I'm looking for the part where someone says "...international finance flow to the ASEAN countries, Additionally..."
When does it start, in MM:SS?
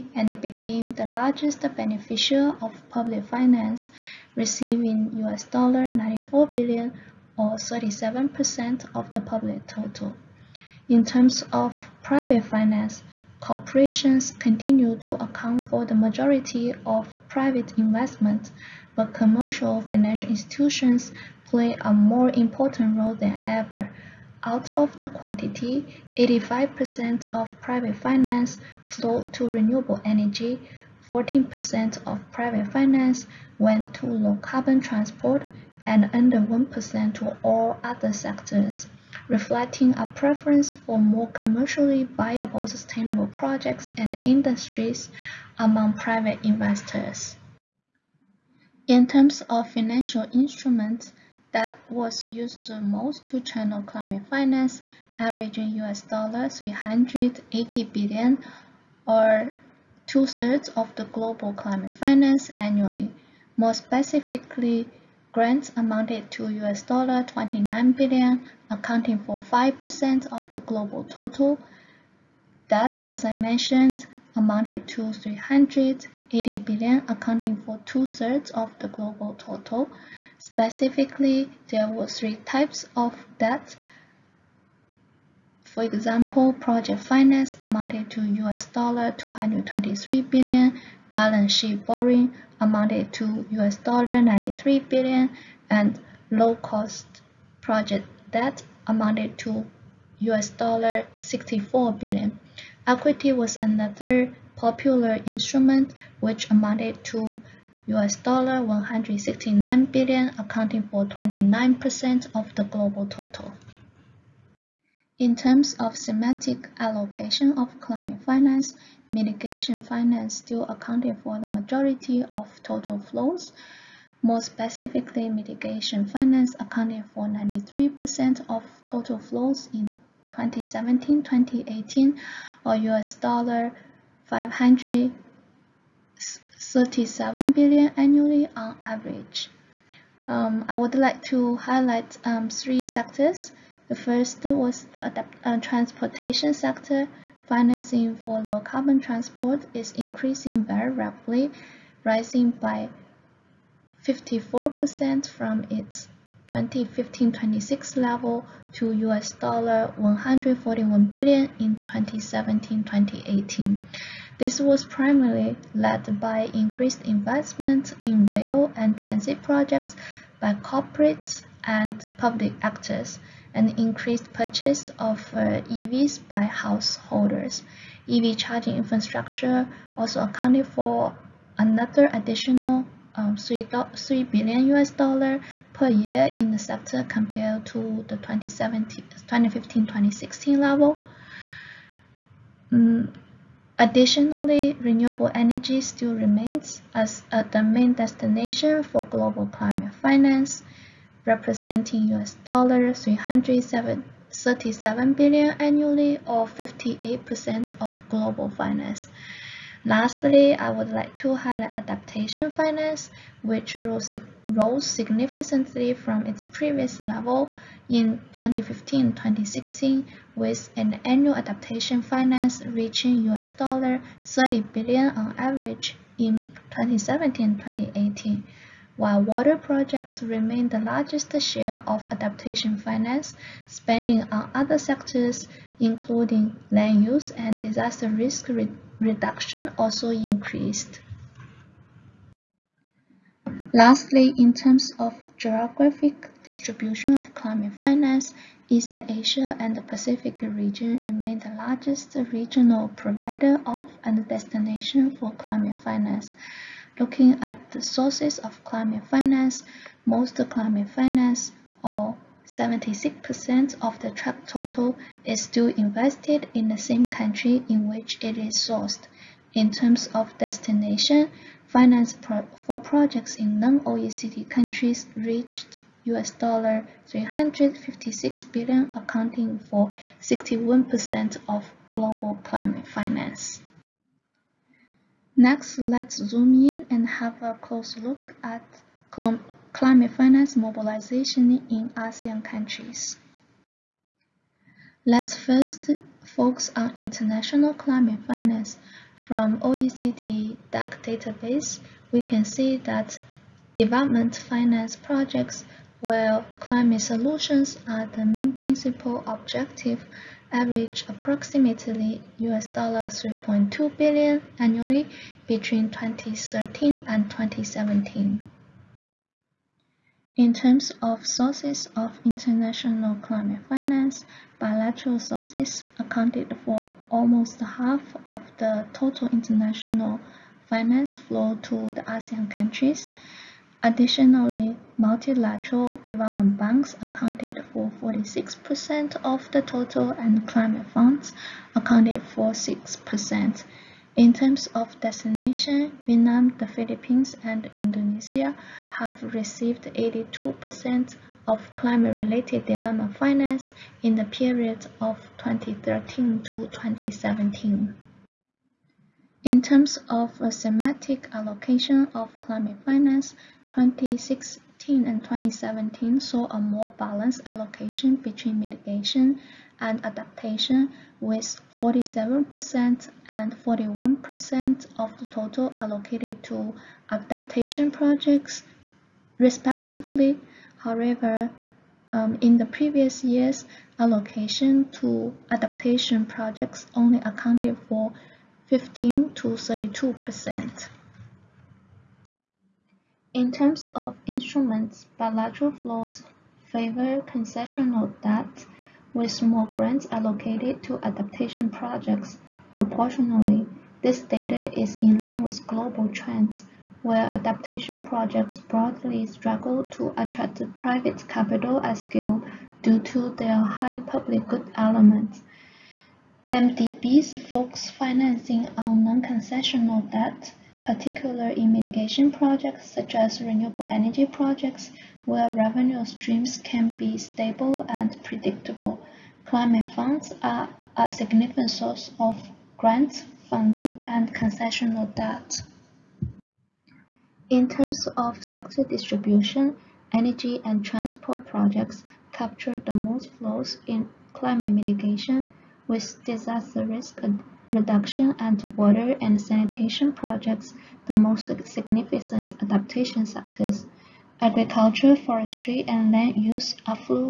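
05:29.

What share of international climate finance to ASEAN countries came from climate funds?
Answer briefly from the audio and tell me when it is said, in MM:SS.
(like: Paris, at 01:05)
6%, at 05:42.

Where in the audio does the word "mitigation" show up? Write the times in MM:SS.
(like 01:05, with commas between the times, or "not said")
01:59, 02:05, 06:08, 07:01, 07:24.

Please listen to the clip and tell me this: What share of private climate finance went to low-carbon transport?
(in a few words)
14%.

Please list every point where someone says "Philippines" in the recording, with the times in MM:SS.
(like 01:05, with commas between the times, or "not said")
05:46.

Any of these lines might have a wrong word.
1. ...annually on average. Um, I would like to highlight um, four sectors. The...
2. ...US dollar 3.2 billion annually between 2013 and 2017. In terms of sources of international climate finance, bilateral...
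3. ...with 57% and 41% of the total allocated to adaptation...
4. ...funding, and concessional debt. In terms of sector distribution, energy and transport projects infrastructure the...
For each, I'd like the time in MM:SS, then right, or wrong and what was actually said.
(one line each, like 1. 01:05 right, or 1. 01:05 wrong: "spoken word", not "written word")
1. 02:17 wrong: "three", not "four"
2. 05:12 right
3. 06:11 wrong: "47", not "57"
4. 07:13 wrong: "capture", not "infrastructure".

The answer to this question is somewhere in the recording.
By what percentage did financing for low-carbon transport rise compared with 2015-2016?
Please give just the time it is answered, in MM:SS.
02:34.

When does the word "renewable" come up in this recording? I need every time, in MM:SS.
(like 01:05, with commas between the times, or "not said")
00:29, 03:14, 07:03.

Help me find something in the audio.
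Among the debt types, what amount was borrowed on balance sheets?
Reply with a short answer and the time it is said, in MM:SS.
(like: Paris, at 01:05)
93 billion US dollars, at 01:33.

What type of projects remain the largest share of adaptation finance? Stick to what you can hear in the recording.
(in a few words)
water projects.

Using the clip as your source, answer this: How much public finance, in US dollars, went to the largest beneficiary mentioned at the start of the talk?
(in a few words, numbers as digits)
94 billion.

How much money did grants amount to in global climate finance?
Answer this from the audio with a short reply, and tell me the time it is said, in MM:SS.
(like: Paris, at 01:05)
29 billion US dollars, at 01:06.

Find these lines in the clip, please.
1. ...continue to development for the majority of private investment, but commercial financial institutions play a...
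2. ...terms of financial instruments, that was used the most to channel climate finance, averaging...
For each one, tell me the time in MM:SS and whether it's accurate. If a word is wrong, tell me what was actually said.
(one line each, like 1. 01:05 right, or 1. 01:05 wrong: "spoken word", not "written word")
1. 00:14 wrong: "account", not "development"
2. 00:49 right.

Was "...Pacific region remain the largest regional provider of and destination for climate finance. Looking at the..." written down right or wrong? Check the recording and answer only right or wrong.
right.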